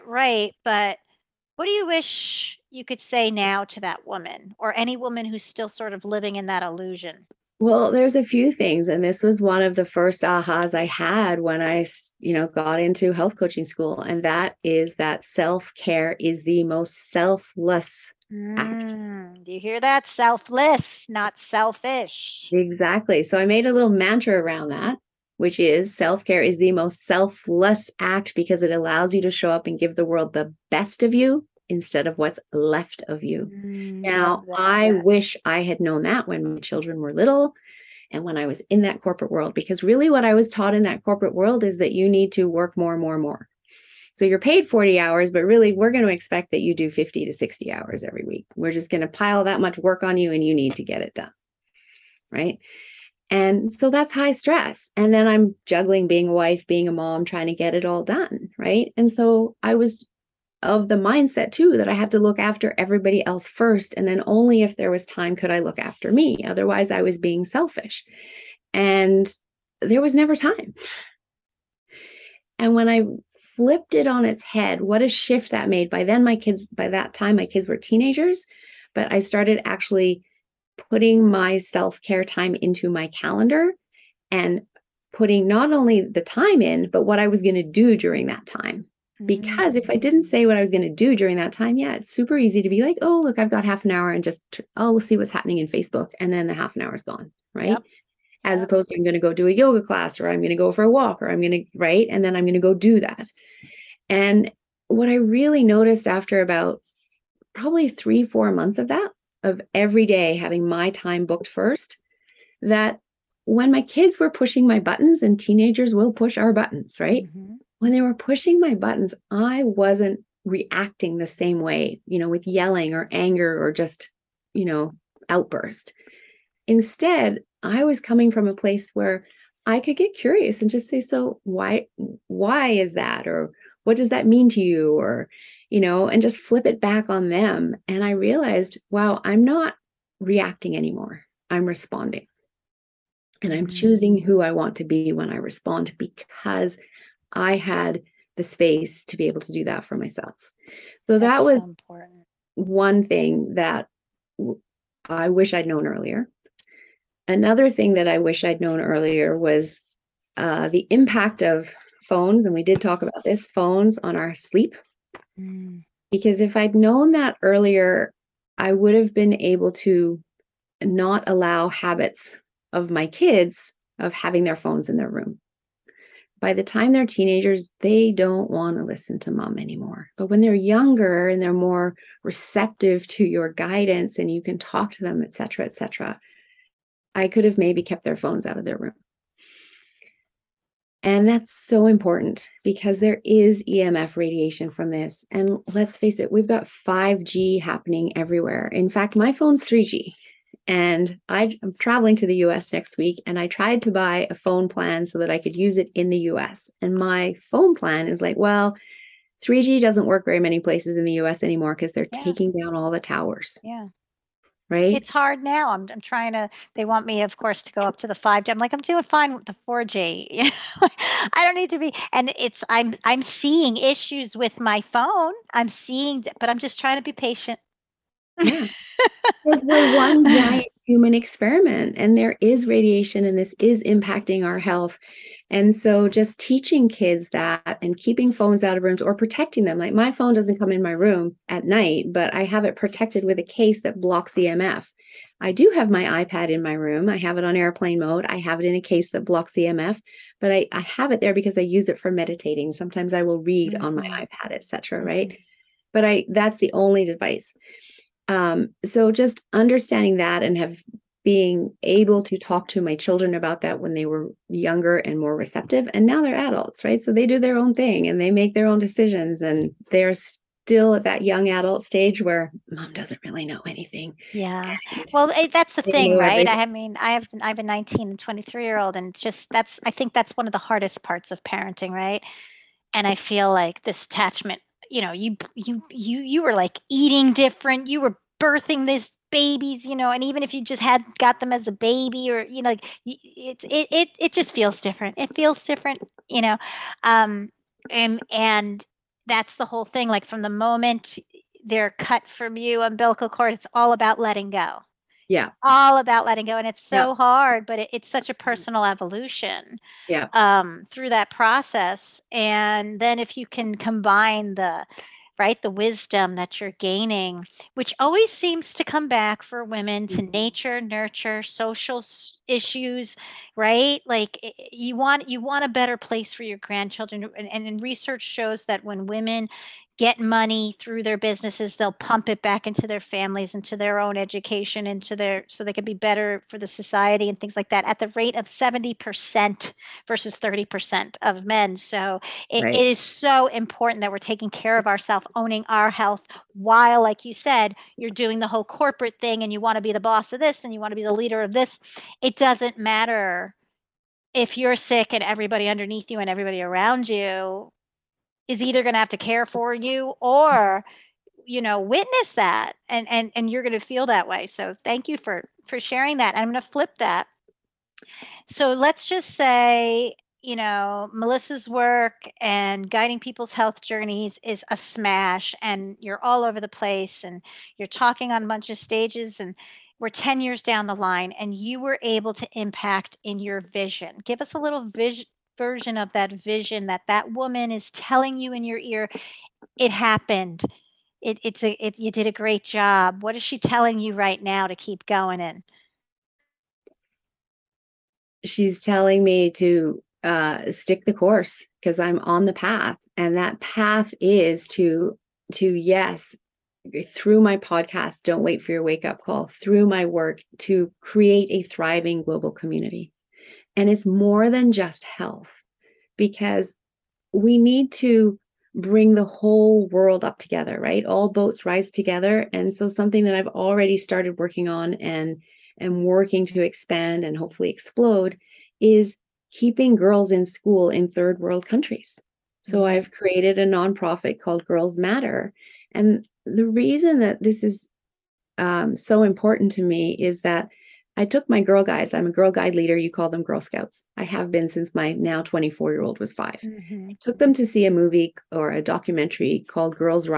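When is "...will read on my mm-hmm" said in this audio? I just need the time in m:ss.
4:13.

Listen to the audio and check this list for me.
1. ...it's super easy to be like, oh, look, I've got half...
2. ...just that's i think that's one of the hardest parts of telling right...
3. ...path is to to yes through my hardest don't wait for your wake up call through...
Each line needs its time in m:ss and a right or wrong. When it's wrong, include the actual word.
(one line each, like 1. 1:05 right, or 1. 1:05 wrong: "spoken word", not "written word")
1. 1:31 right
2. 4:39 wrong: "parenting", not "telling"
3. 6:43 wrong: "podcast", not "hardest".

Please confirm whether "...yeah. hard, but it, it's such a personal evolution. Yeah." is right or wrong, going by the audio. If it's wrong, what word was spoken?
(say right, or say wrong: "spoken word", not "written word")
right.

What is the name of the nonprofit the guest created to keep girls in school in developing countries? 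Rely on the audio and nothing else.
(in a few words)
Girls Matter.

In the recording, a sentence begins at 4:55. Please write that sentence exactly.
It feels different, you know, um, and, and that's the whole thing.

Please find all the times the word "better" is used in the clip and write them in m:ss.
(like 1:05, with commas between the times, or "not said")
5:25, 5:35.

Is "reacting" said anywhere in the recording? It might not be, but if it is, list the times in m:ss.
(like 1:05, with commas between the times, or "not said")
2:00, 2:20.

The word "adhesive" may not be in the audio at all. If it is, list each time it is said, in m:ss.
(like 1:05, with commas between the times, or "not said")
not said.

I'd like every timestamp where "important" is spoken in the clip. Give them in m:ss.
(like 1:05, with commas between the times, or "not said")
2:31, 3:11, 5:43, 7:19.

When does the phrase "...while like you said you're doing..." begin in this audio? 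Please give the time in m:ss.
5:46.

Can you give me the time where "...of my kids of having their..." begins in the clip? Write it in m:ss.
2:52.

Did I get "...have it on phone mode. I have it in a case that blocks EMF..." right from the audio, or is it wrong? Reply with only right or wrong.
wrong.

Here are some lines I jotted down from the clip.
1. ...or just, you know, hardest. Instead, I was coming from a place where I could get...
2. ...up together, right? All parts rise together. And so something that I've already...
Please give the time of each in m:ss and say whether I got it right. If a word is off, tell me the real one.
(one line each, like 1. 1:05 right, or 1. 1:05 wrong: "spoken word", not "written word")
1. 2:03 wrong: "outburst", not "hardest"
2. 7:00 wrong: "boats", not "parts".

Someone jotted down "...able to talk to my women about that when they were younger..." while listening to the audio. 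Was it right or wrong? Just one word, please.
wrong.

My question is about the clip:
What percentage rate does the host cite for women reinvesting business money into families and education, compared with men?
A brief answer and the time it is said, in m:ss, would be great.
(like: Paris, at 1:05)
70%, at 5:38.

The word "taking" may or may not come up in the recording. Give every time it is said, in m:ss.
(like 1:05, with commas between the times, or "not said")
3:32, 5:44.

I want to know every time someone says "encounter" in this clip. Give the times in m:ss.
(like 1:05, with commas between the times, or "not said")
not said.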